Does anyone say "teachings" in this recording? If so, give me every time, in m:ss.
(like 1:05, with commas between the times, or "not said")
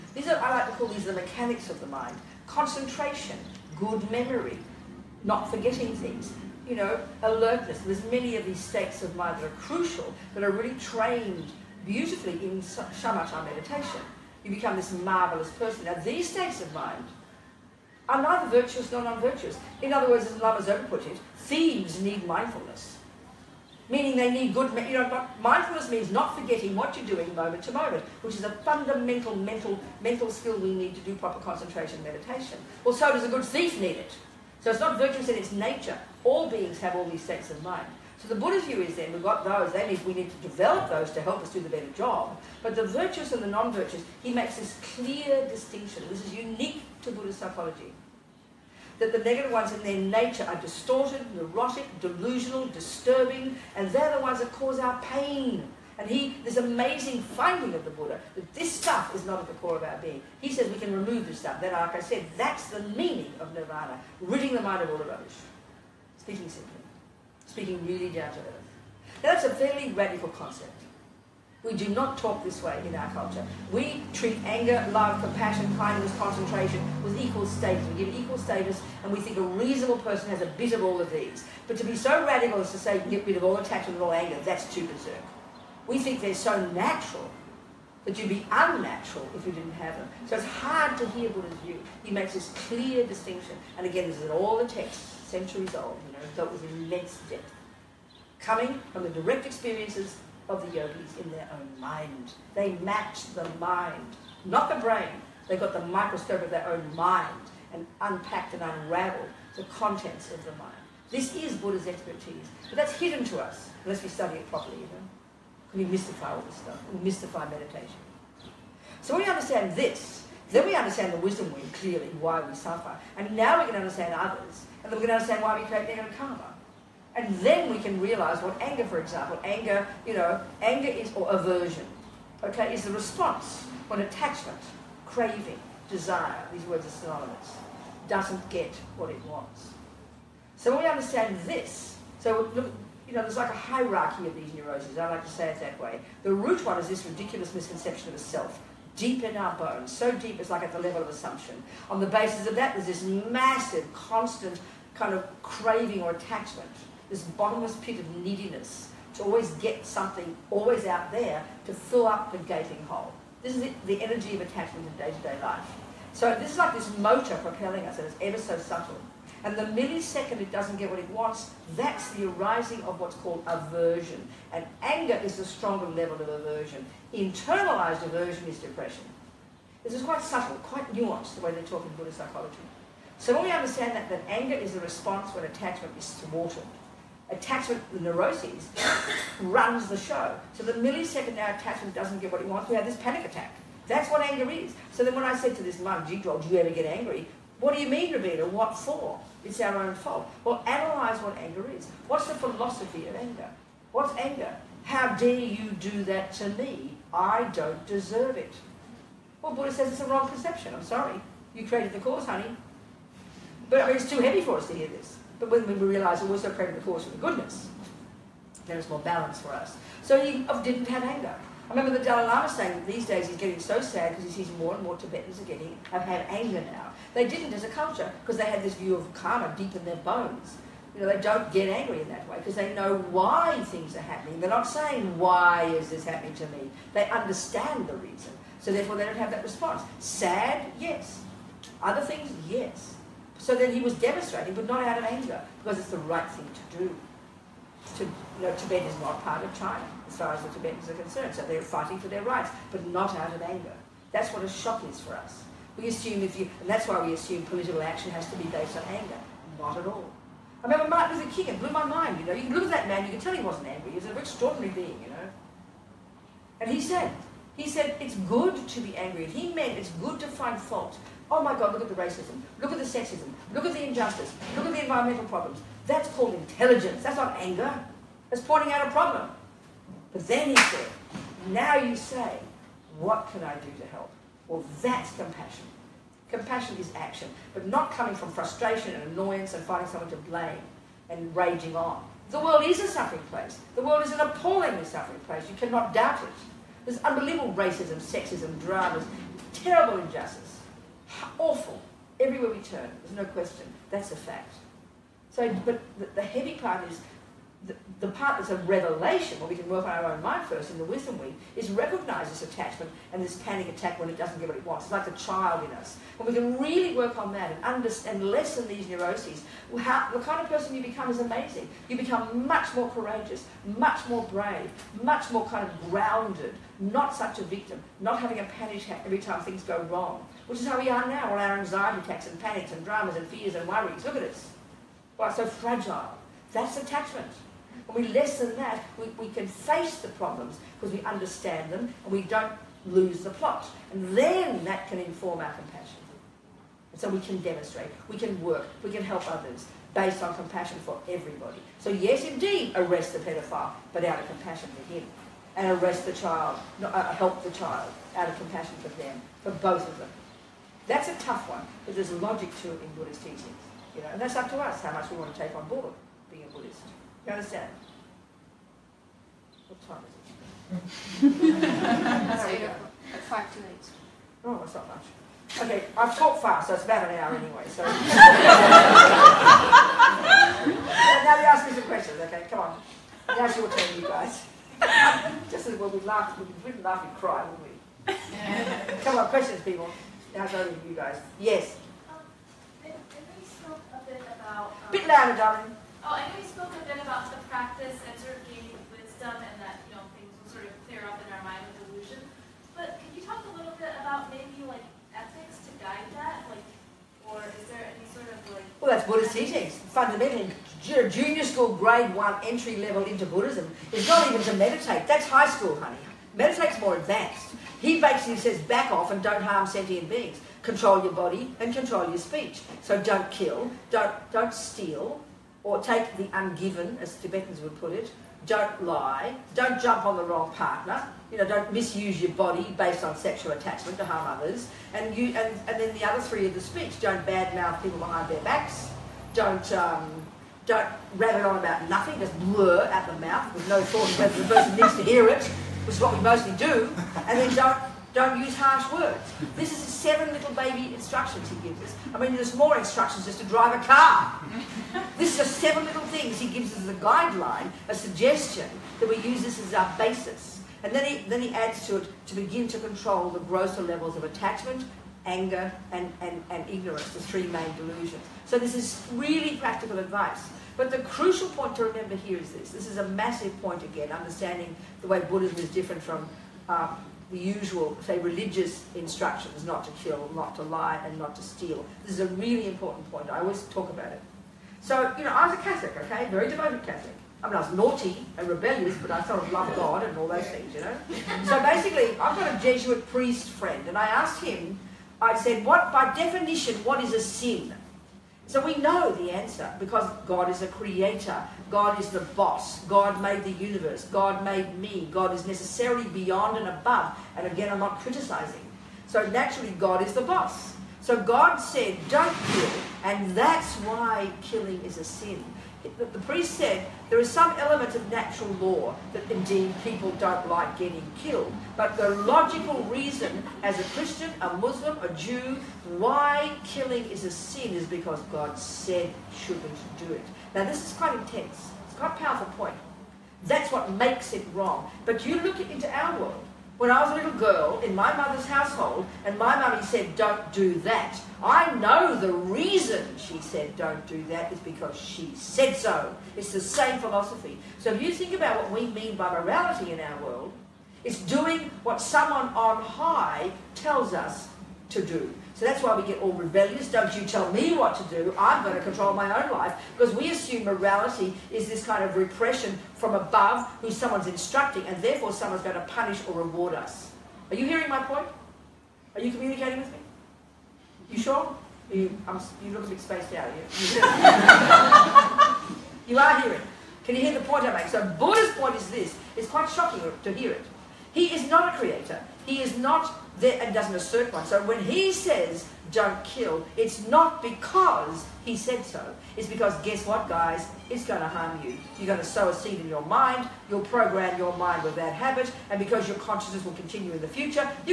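6:03, 6:49.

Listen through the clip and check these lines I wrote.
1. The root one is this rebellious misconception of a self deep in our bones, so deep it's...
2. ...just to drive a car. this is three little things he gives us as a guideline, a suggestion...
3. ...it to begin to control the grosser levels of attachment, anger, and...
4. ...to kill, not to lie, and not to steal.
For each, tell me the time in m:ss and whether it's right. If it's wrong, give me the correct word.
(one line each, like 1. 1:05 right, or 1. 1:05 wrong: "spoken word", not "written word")
1. 2:26 wrong: "ridiculous", not "rebellious"
2. 7:33 wrong: "seven", not "three"
3. 7:41 right
4. 7:59 right.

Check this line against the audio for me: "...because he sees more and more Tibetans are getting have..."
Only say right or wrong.
right.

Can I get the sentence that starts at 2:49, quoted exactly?
And the millisecond it doesn't get what it wants, that's the arising of what's called aversion.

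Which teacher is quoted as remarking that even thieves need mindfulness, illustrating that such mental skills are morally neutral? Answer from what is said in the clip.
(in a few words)
Lama Zopa.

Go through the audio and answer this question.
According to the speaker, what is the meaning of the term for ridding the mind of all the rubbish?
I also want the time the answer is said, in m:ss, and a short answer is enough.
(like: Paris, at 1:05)
nirvana, at 1:03.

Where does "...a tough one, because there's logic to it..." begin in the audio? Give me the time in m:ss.
6:01.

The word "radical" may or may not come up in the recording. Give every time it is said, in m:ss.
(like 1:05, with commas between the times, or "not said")
1:09, 1:22.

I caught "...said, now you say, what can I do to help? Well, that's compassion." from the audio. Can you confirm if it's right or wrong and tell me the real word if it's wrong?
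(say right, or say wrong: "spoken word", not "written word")
right.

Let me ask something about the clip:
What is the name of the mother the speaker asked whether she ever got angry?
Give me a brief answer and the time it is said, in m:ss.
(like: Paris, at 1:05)
Jigdog, at 3:16.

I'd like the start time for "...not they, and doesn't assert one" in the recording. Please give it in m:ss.
9:42.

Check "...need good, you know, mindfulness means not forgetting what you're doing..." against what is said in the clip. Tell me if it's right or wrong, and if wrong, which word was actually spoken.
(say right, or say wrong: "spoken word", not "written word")
right.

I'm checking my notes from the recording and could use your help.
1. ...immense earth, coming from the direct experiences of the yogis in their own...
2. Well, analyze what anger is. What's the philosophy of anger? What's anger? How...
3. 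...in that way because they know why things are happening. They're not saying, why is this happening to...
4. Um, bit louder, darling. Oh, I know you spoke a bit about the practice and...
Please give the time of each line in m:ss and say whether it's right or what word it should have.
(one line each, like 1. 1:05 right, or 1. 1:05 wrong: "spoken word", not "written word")
1. 1:36 wrong: "depth", not "earth"
2. 3:20 right
3. 3:52 right
4. 6:34 right.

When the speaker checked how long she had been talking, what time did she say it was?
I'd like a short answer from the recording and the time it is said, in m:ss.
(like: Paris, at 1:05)
five to eight, at 6:13.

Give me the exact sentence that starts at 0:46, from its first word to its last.
This is unique to Buddhist psychology.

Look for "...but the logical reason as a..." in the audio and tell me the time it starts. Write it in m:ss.
8:41.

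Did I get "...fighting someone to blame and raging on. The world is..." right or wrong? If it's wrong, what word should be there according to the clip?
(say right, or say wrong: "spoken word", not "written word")
wrong: "finding", not "fighting".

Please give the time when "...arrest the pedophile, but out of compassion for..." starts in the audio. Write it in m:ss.
5:52.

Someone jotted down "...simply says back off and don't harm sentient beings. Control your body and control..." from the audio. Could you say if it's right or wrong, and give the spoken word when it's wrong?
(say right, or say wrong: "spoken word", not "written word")
wrong: "basically", not "simply".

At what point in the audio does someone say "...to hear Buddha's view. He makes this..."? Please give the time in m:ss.
1:30.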